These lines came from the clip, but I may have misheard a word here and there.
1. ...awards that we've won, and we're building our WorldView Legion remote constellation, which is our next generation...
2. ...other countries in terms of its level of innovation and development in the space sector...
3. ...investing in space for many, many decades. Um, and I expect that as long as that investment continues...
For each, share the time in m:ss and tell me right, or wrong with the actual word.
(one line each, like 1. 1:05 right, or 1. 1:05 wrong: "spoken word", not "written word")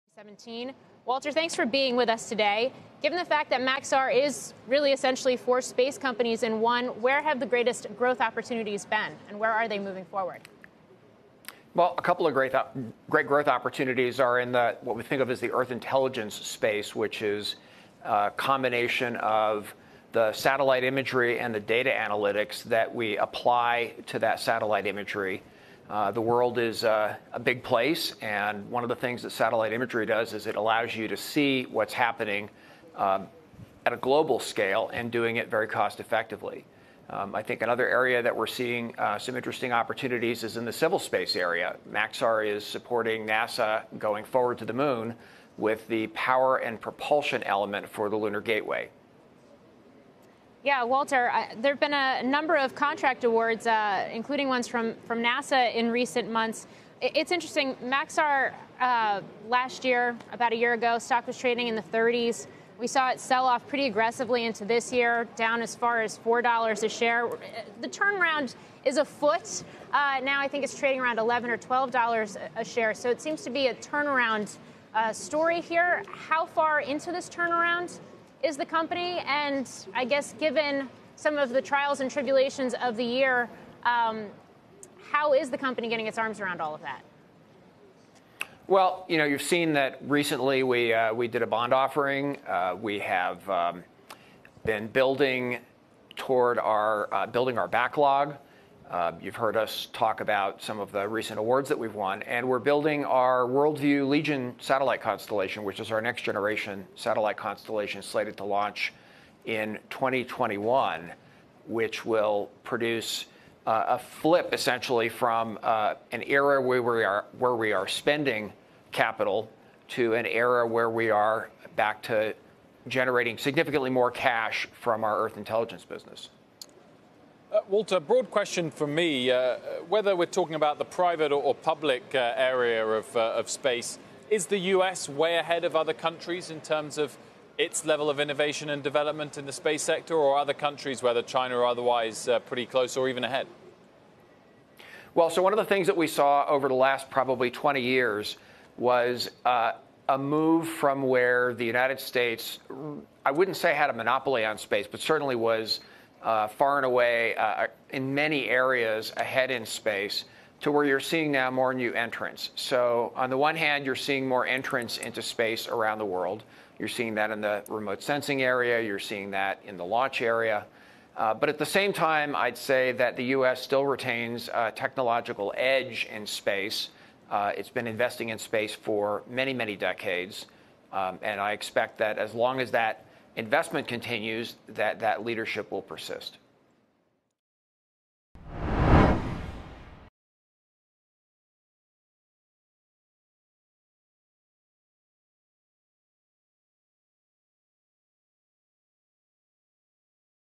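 1. 1:41 wrong: "satellite", not "remote"
2. 2:15 right
3. 2:57 right.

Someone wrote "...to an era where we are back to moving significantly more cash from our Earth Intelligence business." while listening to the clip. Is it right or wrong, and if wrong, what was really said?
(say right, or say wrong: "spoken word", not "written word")
wrong: "generating", not "moving".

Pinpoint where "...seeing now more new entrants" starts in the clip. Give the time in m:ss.
2:40.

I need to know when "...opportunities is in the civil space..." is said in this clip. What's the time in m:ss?
0:39.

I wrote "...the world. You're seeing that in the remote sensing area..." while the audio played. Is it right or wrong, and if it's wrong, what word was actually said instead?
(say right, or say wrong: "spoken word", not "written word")
right.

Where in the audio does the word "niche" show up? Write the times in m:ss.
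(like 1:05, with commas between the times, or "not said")
not said.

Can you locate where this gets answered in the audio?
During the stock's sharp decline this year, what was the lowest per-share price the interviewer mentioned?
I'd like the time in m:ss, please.
1:06.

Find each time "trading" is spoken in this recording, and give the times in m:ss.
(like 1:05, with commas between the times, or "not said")
1:01, 1:10.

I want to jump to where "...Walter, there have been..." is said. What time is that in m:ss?
0:50.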